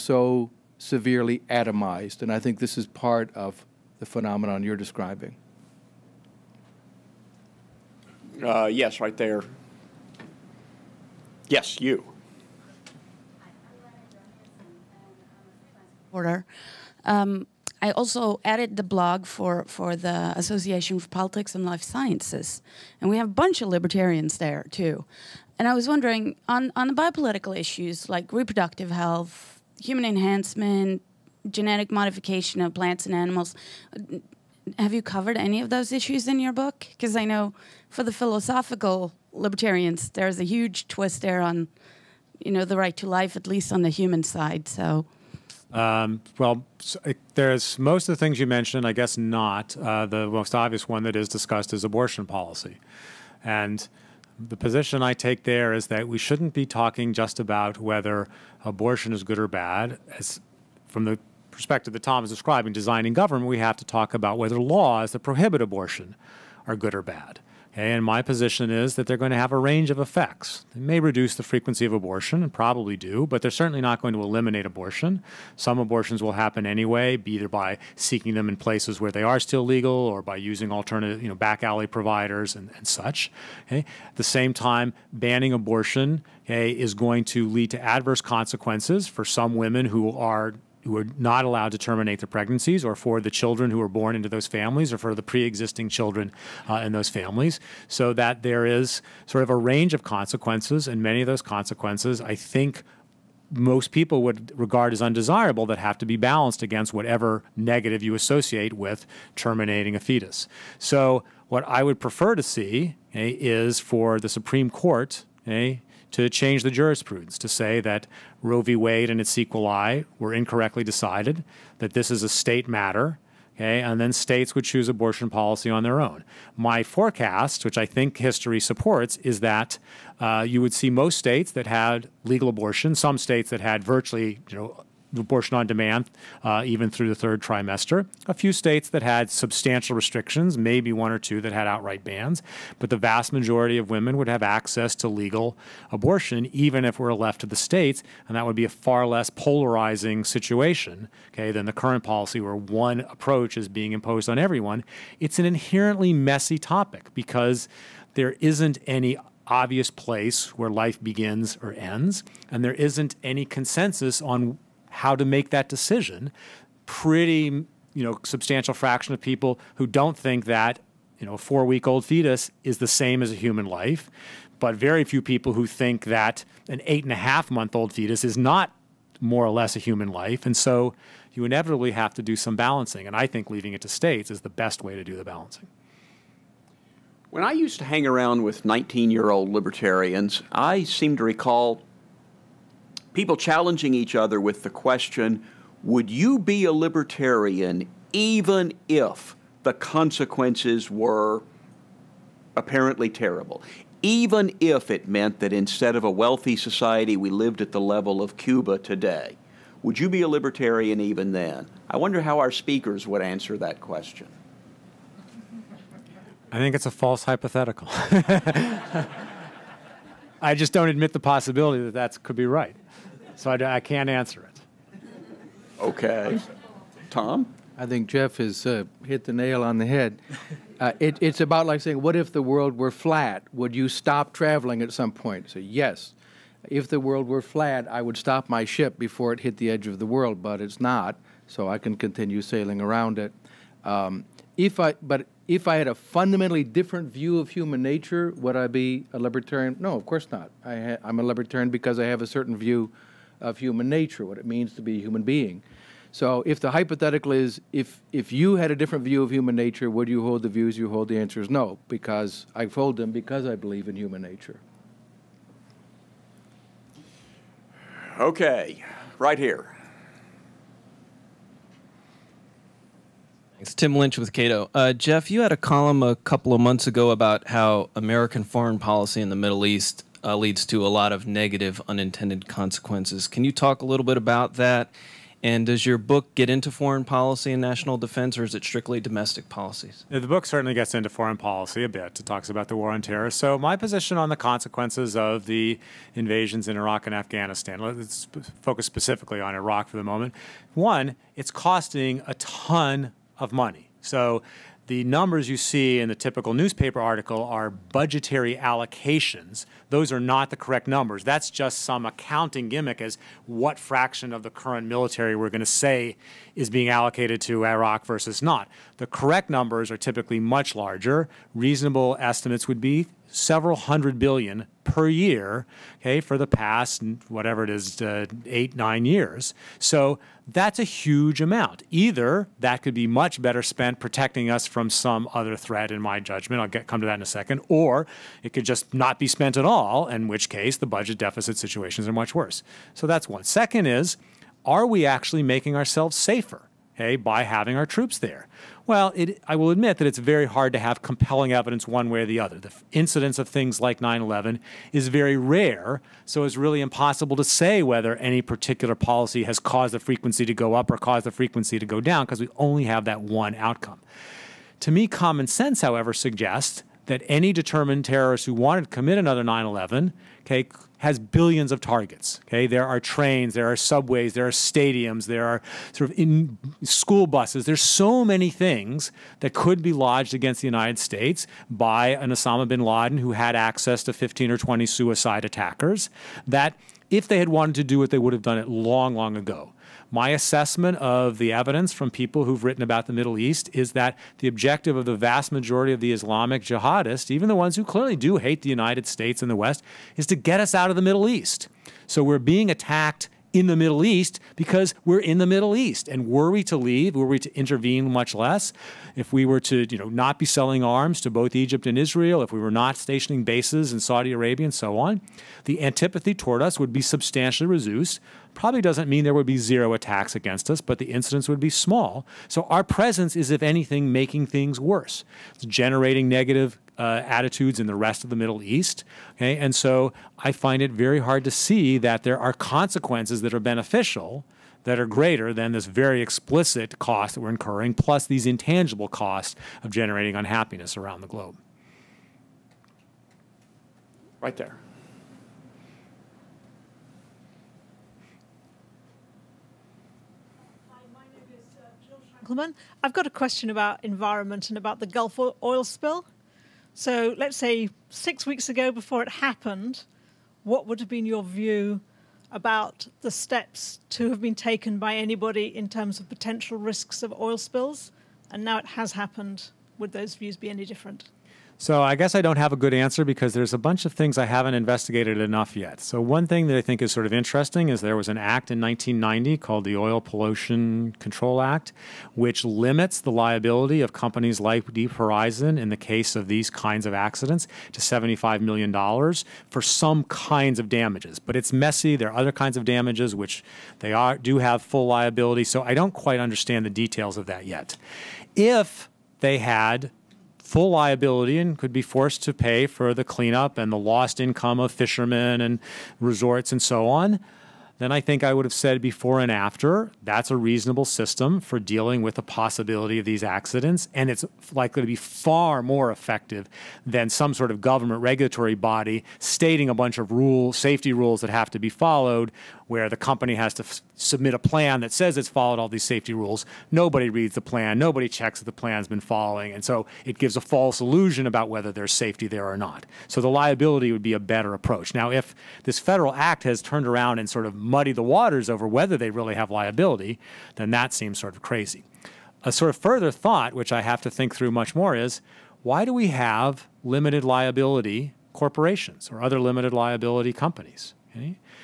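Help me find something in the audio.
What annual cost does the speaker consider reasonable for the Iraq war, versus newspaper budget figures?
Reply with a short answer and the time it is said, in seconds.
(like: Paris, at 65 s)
several hundred billion, at 323 s.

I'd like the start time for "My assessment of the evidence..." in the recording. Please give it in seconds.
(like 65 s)
390 s.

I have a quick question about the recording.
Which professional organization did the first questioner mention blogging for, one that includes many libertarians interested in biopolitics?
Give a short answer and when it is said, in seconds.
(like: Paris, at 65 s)
Association for Politics and Life Sciences, at 20 s.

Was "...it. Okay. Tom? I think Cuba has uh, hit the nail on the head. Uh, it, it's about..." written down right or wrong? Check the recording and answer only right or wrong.
wrong.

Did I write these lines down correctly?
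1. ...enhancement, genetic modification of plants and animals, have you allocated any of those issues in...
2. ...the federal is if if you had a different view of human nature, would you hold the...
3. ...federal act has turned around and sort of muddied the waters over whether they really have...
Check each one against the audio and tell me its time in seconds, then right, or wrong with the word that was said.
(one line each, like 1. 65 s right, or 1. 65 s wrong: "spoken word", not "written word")
1. 30 s wrong: "covered", not "allocated"
2. 256 s wrong: "hypothetical", not "federal"
3. 535 s right.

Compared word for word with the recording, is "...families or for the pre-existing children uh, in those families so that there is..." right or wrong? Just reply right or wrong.
right.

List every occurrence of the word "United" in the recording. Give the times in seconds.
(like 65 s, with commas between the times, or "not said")
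380 s, 398 s.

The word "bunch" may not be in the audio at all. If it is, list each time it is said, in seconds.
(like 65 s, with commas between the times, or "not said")
23 s, 473 s, 519 s.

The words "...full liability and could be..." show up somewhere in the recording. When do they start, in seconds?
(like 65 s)
500 s.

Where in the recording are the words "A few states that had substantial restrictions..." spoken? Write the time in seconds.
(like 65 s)
138 s.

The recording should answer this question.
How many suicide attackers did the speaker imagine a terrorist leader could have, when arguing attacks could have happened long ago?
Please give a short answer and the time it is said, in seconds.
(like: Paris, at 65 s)
15 or 20, at 384 s.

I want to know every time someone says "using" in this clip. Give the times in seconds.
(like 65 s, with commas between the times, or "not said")
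80 s.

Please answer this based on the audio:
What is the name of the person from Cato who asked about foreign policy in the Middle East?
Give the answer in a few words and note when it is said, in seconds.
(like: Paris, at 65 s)
Tim Lynch, at 273 s.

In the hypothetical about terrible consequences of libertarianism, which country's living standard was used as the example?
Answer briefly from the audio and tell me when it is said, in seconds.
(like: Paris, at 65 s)
Cuba, at 208 s.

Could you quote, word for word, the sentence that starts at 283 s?
Can you talk a little bit about that?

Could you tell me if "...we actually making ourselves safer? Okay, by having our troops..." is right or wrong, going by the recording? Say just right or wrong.
right.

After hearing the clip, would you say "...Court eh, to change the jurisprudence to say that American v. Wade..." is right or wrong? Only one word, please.
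wrong.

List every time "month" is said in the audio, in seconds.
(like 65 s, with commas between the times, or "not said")
177 s, 276 s.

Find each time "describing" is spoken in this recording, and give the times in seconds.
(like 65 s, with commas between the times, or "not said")
4 s, 62 s.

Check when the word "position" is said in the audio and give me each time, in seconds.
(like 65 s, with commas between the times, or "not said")
54 s, 68 s, 293 s.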